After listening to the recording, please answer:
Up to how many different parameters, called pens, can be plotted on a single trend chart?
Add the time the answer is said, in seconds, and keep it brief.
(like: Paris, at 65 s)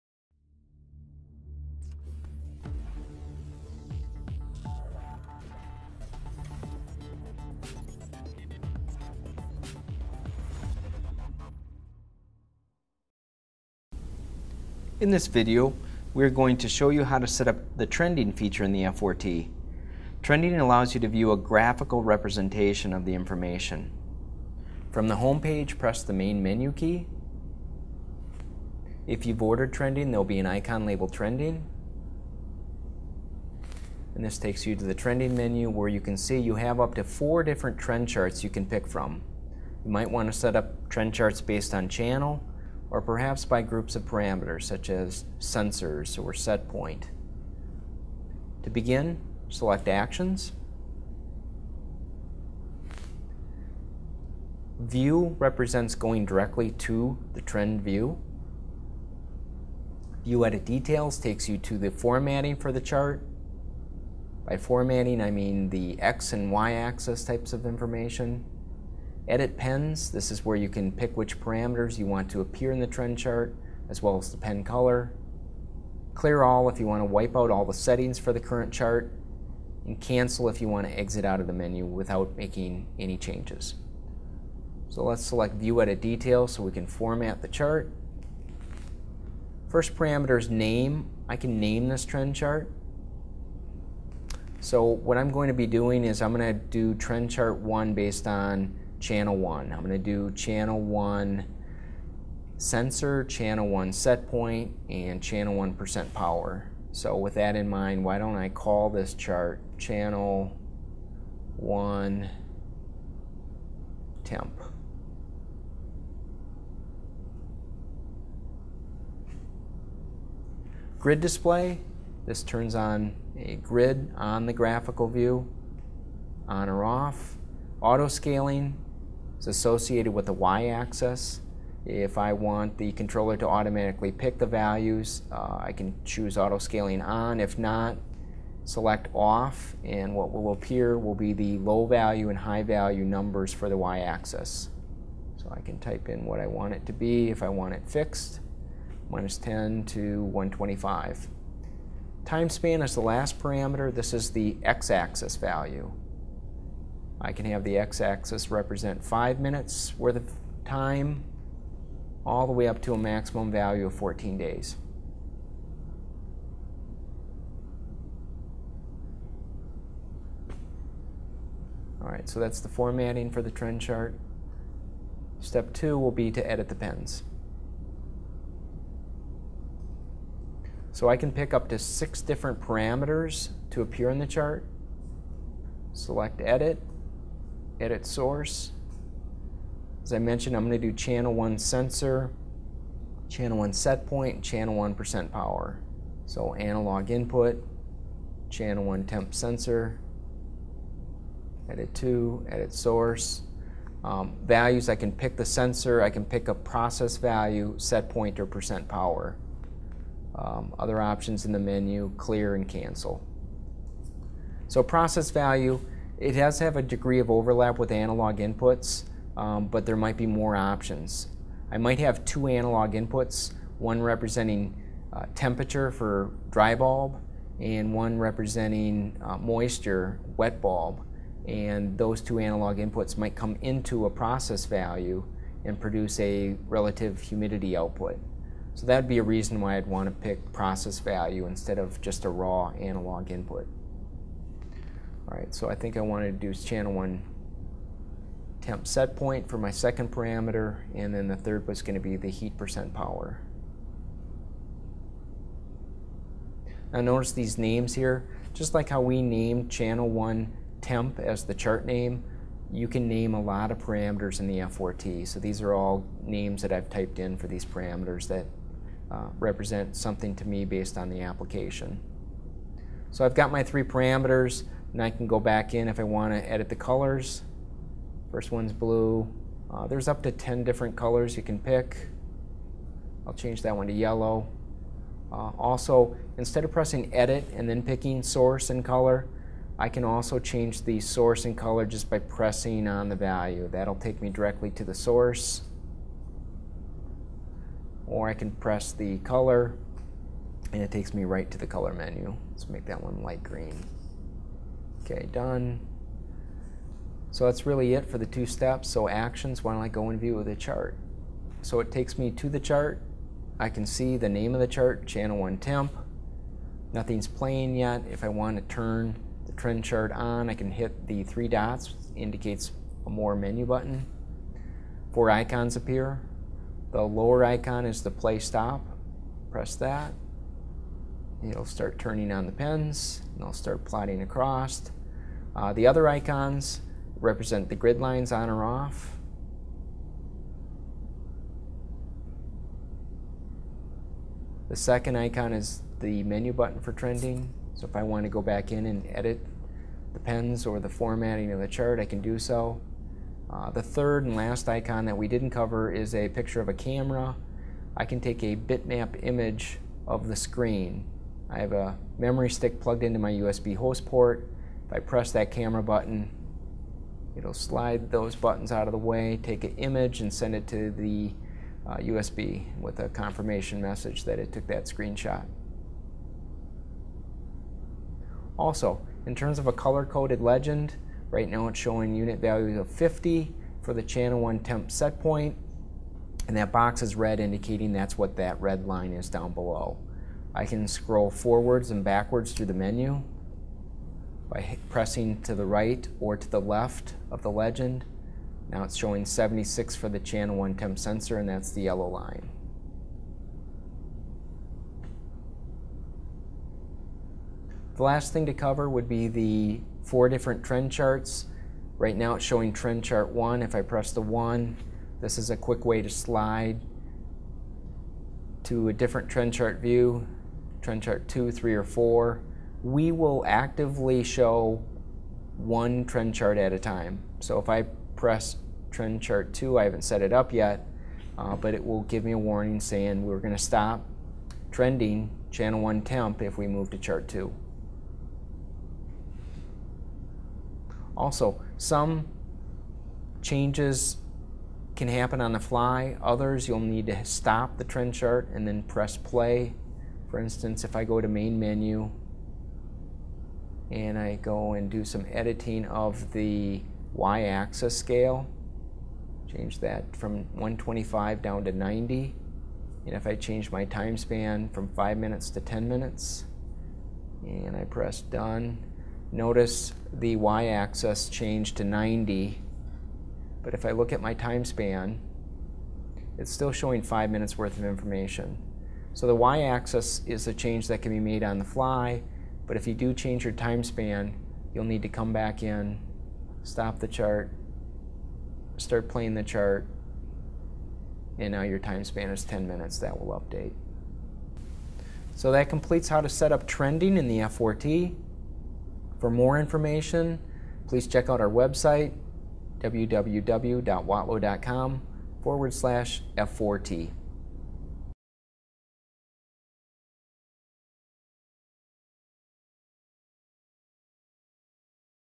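6, at 181 s.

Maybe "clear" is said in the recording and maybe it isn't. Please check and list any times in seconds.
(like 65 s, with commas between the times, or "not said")
76 s, 212 s.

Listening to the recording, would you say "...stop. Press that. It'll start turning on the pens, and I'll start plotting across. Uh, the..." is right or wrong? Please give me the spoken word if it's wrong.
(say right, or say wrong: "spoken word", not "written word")
right.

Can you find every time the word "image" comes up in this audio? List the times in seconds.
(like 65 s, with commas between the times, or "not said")
359 s, 369 s.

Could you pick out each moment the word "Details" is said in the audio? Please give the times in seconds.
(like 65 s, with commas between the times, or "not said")
60 s, 86 s.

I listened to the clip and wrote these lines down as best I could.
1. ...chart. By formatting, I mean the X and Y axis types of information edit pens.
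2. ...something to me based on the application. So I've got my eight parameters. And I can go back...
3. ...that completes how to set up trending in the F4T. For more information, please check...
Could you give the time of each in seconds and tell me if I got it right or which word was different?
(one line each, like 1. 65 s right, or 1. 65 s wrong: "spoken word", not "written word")
1. 62 s right
2. 269 s wrong: "three", not "eight"
3. 495 s right.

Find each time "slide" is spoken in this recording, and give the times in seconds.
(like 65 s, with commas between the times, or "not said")
367 s, 416 s.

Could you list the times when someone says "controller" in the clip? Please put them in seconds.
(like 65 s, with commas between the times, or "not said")
132 s.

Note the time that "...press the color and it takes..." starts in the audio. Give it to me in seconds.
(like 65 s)
298 s.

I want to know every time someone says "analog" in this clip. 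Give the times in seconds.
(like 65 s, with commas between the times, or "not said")
196 s, 217 s, 222 s, 232 s, 242 s.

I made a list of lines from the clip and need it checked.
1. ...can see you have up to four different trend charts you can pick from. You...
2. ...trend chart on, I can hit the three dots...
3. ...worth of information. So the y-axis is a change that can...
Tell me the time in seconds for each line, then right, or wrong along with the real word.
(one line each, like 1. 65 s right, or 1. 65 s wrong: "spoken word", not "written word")
1. 35 s right
2. 319 s right
3. 477 s right.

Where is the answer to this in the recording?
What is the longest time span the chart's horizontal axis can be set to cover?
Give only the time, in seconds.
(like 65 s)
163 s.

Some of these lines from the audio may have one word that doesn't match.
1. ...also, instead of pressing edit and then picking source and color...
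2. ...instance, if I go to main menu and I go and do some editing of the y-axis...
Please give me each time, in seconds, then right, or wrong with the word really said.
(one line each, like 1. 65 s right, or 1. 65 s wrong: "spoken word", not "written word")
1. 285 s right
2. 450 s right.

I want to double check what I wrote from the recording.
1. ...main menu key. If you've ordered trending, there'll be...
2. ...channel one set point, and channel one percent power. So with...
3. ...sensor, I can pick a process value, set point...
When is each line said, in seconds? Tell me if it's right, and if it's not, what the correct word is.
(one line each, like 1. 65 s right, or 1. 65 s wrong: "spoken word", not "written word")
1. 26 s right
2. 103 s right
3. 205 s right.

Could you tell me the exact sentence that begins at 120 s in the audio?
Grid display, this turns on a grid on the graphical view, on or off.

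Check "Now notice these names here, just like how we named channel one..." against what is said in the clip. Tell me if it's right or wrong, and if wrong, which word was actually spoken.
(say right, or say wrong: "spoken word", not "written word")
right.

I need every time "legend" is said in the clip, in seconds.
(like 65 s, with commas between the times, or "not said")
380 s, 397 s.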